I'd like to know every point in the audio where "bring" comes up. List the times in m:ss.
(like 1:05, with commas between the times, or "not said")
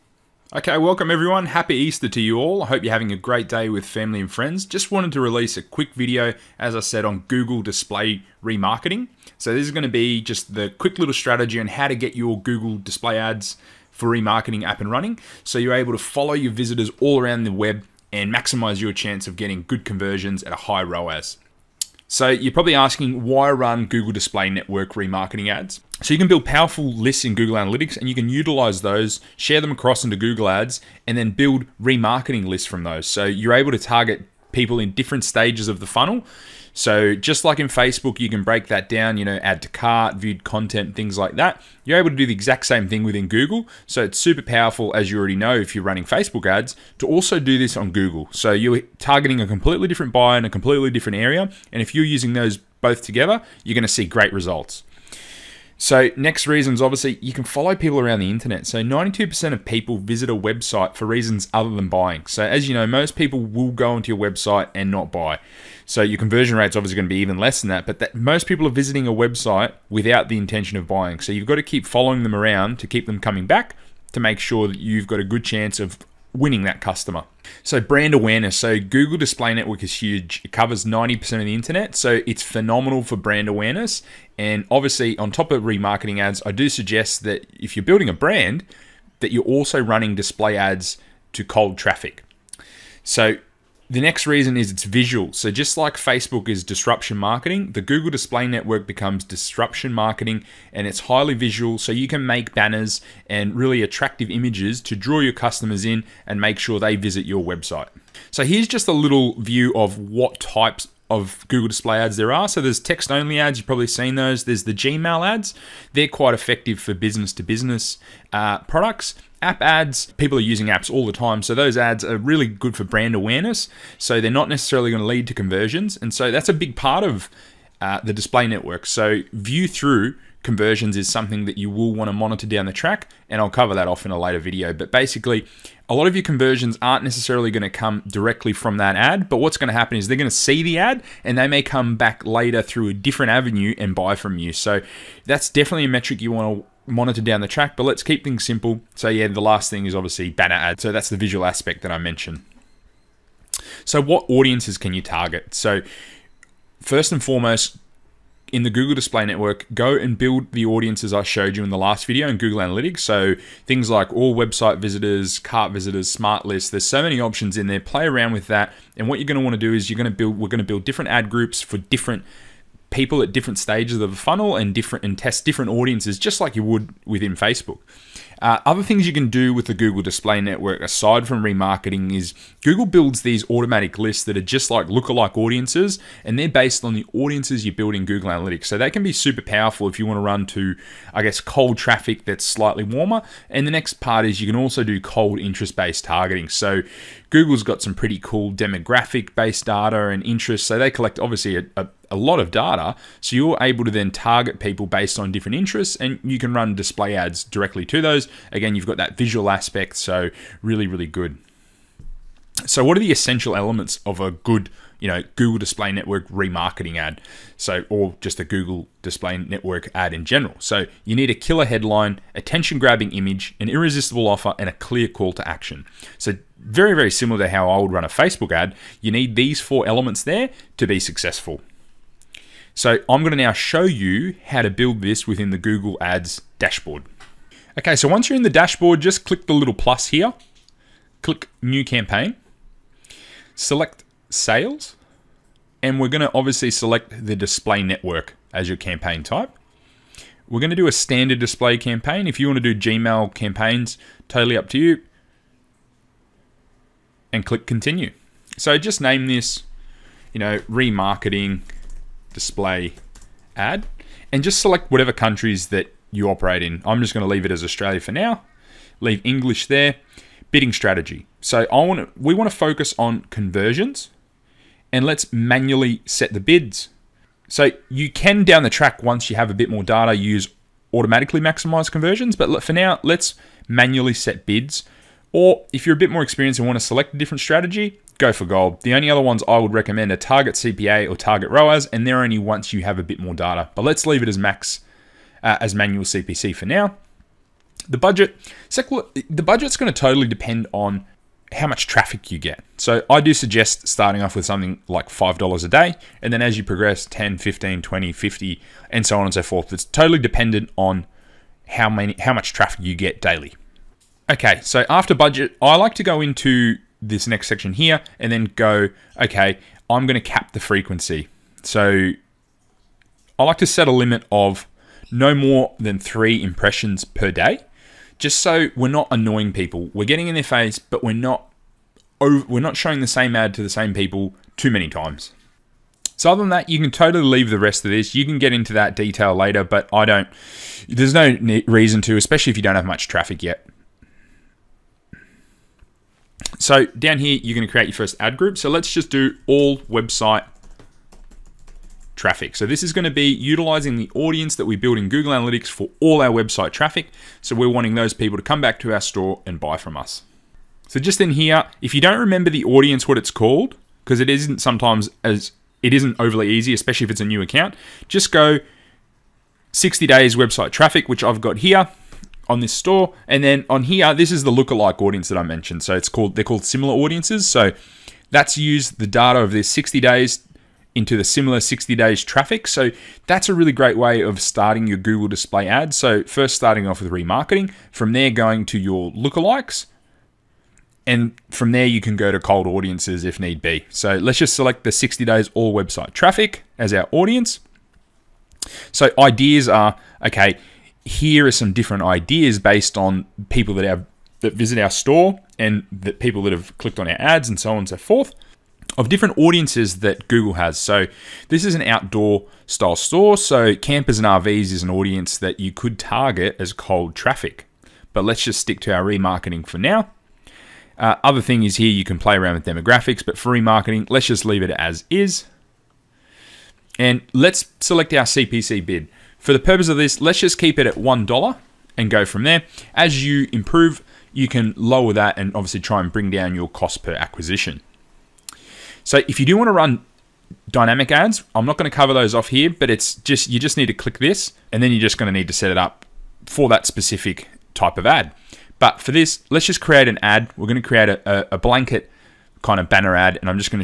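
7:16.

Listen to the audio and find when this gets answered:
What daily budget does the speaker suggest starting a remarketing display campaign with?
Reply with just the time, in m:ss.
5:05.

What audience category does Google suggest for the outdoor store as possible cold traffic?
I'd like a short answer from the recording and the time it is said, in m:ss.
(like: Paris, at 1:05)
campers and RVs, at 6:53.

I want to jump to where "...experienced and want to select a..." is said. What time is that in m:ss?
4:46.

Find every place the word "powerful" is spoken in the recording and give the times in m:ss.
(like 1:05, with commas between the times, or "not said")
0:26, 0:44, 3:09.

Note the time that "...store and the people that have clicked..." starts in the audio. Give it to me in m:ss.
6:44.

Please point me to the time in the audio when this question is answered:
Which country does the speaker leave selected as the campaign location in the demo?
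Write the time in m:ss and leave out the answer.
4:27.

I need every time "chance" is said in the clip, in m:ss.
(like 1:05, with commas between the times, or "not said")
0:18, 1:15.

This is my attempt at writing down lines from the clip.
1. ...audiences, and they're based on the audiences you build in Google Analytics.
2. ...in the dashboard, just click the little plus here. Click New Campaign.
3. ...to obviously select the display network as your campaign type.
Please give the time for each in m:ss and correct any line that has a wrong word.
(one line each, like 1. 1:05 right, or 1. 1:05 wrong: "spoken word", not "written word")
1. 3:05 right
2. 3:58 right
3. 4:06 right.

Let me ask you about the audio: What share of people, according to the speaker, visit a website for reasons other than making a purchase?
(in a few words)
92%.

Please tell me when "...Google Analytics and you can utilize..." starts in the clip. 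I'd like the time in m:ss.
0:27.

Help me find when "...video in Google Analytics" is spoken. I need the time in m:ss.
2:42.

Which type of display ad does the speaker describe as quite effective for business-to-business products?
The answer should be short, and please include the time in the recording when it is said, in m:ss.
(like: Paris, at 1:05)
Gmail ads, at 1:54.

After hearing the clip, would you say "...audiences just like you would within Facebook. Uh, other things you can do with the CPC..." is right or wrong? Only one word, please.
wrong.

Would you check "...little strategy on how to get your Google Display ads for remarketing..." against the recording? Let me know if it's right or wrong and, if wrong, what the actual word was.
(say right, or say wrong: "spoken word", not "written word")
right.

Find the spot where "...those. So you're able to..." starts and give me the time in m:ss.
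0:32.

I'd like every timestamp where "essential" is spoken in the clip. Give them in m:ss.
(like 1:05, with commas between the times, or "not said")
3:33.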